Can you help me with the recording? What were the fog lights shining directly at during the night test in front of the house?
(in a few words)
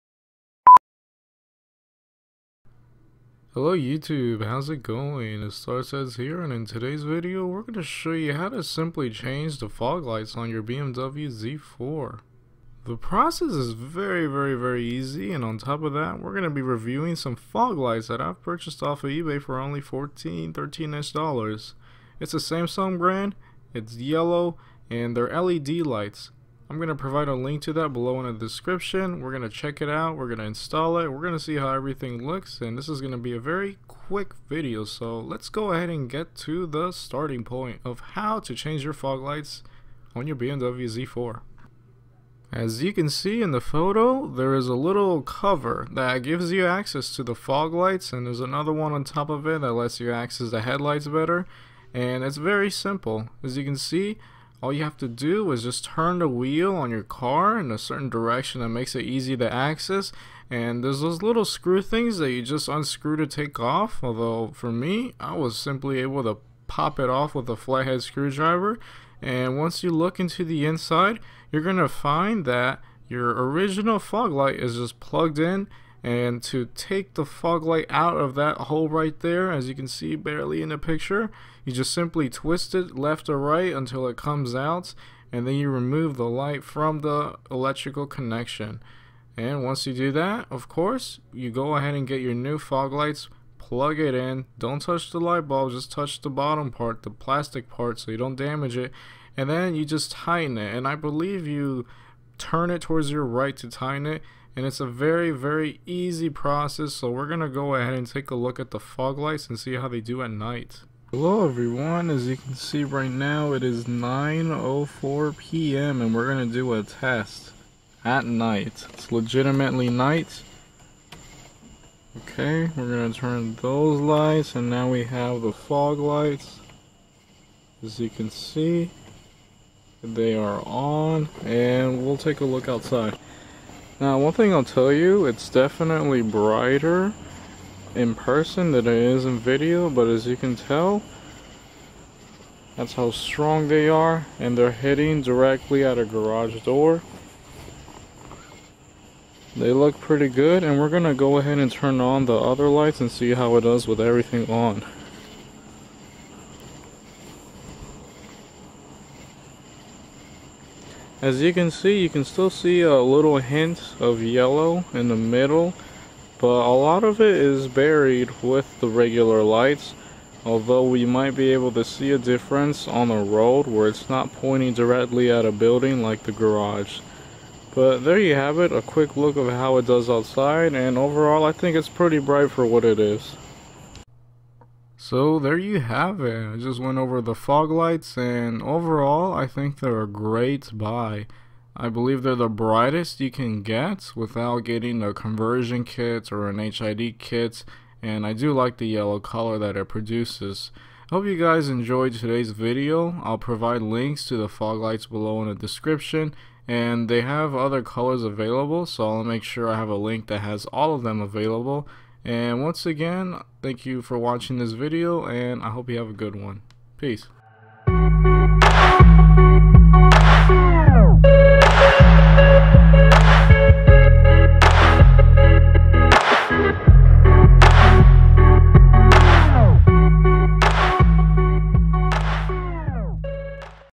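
A garage door.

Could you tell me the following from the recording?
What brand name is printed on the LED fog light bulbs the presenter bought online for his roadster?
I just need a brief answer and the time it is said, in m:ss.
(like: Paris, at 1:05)
Samsung, at 0:22.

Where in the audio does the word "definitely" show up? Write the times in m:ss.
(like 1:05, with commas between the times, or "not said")
2:15.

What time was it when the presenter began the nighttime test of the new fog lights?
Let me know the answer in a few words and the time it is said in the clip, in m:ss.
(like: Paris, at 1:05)
9:04 p.m., at 1:53.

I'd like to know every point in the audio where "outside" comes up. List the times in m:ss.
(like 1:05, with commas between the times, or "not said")
2:12, 3:00.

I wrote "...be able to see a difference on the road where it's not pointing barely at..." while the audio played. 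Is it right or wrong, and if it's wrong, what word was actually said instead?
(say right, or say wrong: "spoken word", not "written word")
wrong: "directly", not "barely".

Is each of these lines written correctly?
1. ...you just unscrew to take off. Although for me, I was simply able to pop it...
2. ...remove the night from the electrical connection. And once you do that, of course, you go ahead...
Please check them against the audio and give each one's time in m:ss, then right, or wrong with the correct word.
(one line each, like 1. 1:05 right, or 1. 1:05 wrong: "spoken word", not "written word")
1. 1:02 right
2. 1:25 wrong: "light", not "night".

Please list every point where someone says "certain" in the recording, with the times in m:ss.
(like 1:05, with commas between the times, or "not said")
0:57.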